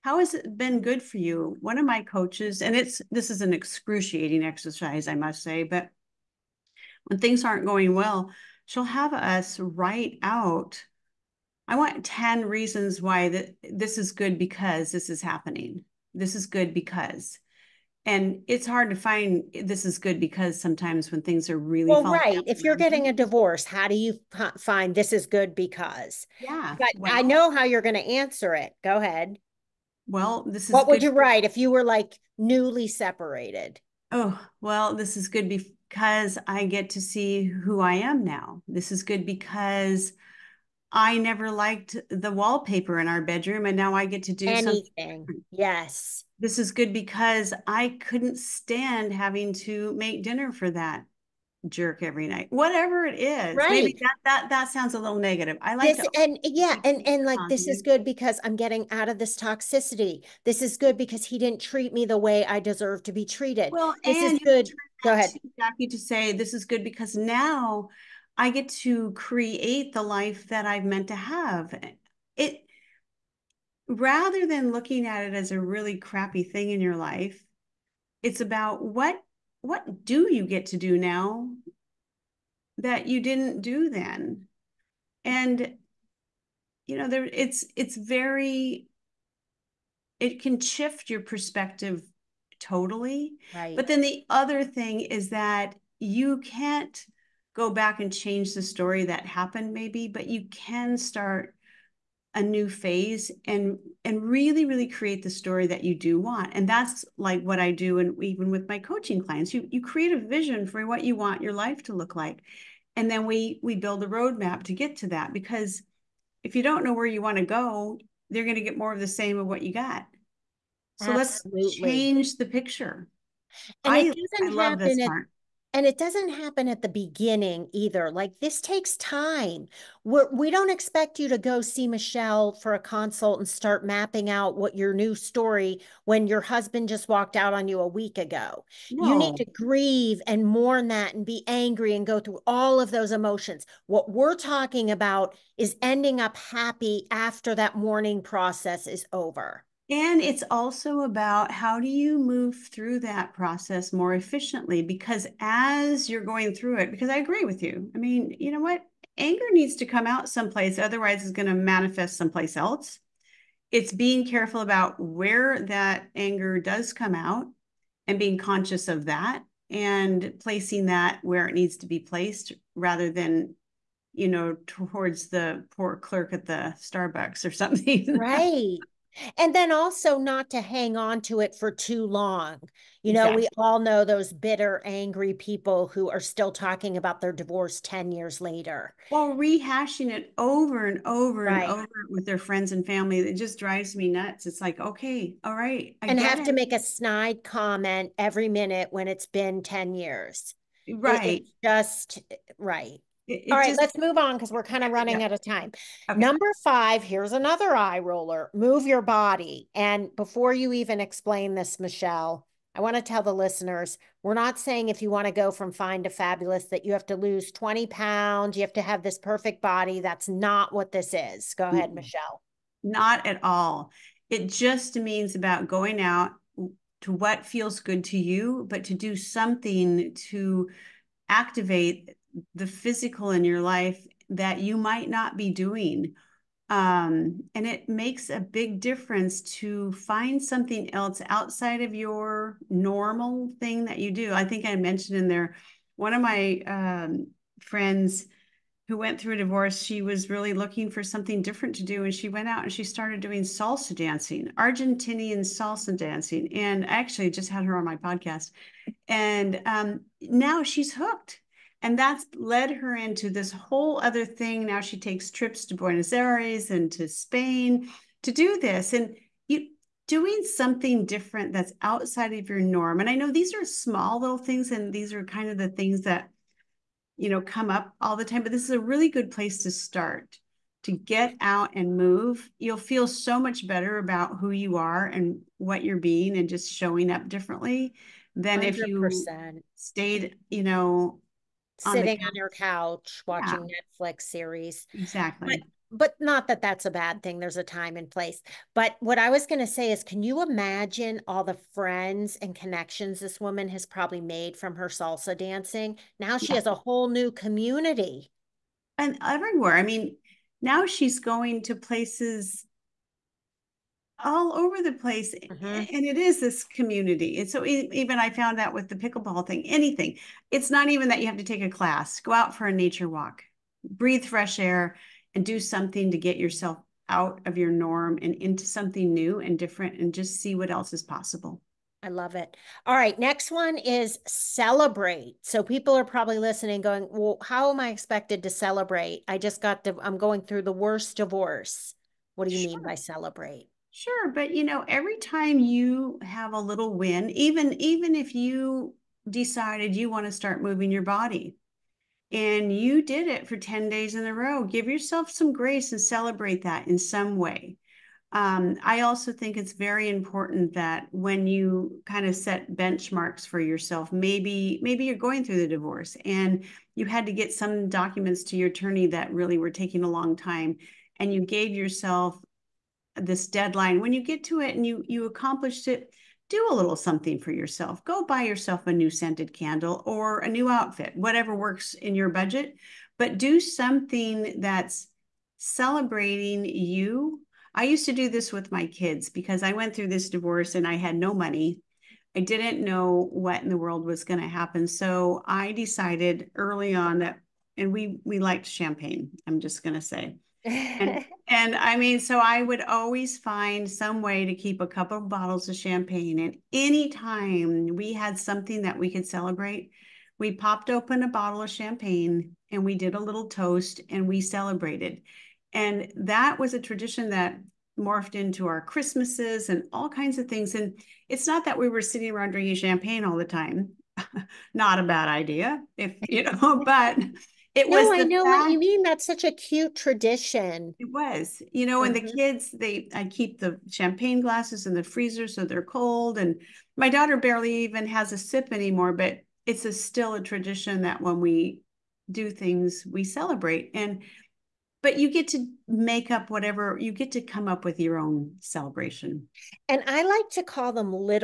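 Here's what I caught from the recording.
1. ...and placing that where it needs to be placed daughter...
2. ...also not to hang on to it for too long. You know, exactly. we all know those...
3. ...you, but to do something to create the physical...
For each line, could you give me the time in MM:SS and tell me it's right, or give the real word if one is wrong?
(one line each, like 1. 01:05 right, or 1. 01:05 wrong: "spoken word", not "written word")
1. 02:49 wrong: "rather", not "daughter"
2. 02:59 right
3. 03:48 wrong: "activate", not "create".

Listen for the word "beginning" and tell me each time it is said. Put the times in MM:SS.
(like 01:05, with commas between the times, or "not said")
02:06.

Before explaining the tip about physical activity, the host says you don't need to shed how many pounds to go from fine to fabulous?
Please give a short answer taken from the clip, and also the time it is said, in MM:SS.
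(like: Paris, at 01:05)
20, at 03:37.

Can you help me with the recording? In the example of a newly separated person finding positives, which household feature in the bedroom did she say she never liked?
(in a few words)
wallpaper.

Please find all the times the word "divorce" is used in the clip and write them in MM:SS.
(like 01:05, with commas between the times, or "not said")
00:23, 03:07, 04:09, 05:41, 06:05, 06:30.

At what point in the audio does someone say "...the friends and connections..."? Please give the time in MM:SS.
05:01.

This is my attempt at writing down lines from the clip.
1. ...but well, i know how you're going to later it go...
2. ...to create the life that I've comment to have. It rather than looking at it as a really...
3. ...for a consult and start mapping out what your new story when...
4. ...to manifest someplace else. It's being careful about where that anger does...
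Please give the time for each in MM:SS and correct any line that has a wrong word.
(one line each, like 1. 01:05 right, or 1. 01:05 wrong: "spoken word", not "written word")
1. 00:26 wrong: "answer", not "later"
2. 01:08 wrong: "meant", not "comment"
3. 02:12 right
4. 02:41 right.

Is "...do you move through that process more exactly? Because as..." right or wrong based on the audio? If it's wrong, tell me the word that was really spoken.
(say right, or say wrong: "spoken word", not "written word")
wrong: "efficiently", not "exactly".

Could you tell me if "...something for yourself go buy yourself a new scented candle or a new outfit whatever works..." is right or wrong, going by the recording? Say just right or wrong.
right.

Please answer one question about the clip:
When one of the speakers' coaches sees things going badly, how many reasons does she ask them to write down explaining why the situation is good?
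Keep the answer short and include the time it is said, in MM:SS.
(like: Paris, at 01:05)
10, at 00:12.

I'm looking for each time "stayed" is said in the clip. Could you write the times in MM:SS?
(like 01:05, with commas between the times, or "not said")
04:49.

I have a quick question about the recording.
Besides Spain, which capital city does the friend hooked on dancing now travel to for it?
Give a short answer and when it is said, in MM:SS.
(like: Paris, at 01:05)
Buenos Aires, at 04:25.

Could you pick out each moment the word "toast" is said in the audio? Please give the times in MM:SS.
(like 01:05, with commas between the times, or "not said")
06:53.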